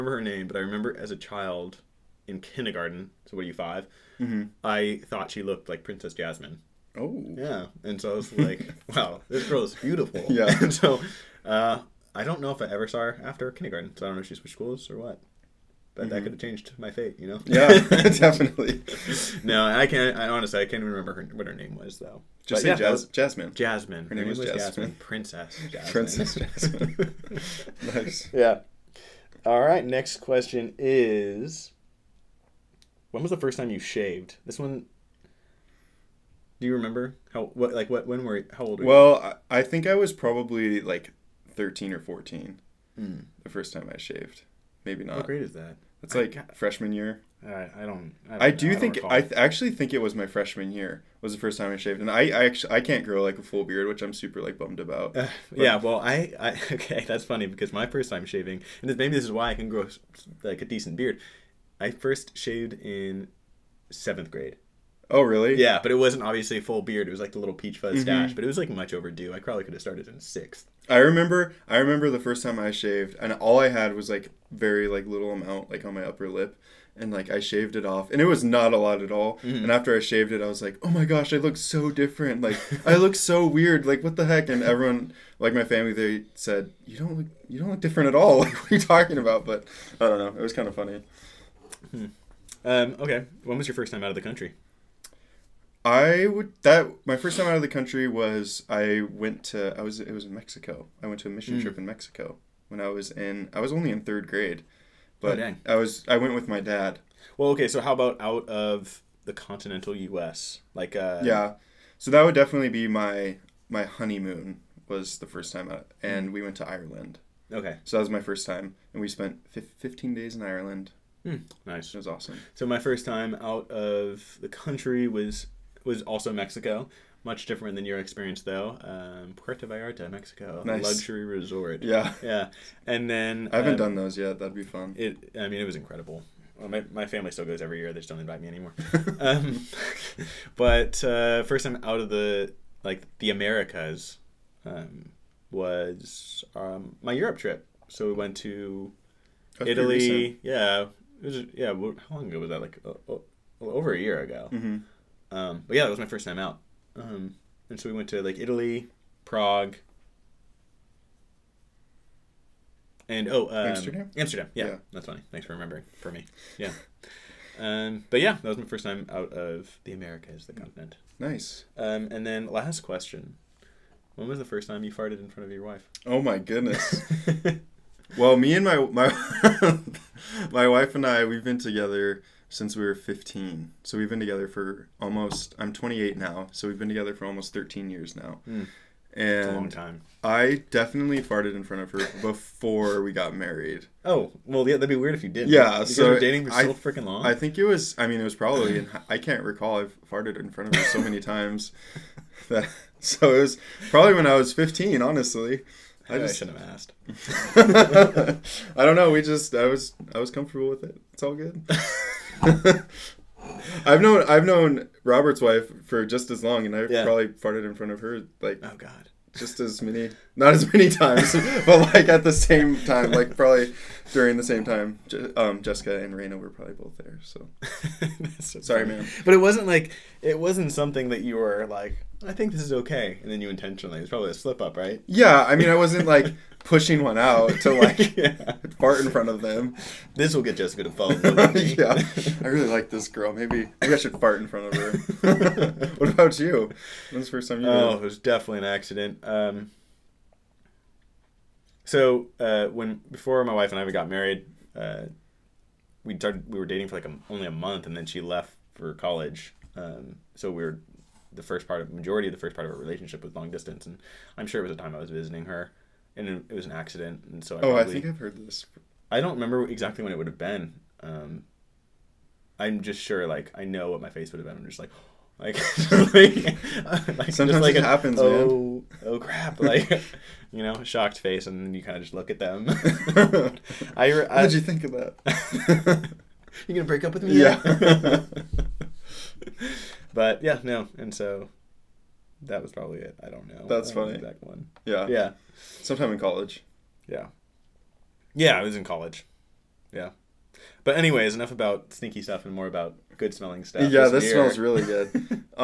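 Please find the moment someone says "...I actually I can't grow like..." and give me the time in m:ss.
0:52.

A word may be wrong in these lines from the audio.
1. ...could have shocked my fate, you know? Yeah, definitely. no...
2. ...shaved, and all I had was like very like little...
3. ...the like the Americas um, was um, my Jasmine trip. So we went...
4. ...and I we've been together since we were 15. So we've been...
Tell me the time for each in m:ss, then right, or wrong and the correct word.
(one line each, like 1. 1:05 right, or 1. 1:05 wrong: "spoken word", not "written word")
1. 0:16 wrong: "changed", not "shocked"
2. 1:12 right
3. 2:22 wrong: "Europe", not "Jasmine"
4. 3:00 right.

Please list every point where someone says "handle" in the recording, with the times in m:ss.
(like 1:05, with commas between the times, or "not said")
not said.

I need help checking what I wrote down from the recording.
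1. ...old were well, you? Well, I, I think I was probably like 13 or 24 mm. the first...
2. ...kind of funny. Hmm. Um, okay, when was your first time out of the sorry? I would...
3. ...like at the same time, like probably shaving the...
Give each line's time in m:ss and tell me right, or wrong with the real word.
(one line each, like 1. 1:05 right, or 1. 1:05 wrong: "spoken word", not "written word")
1. 0:38 wrong: "14", not "24"
2. 1:30 wrong: "country", not "sorry"
3. 3:41 wrong: "during", not "shaving".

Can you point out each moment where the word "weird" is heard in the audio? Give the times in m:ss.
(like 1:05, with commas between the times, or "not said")
1:23, 3:14.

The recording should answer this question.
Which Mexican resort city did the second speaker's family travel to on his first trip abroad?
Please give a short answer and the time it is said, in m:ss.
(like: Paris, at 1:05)
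Puerto Vallarta, at 2:09.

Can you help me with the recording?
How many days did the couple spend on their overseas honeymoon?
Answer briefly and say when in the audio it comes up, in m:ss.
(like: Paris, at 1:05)
15, at 1:59.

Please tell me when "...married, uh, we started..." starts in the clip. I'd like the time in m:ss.
4:14.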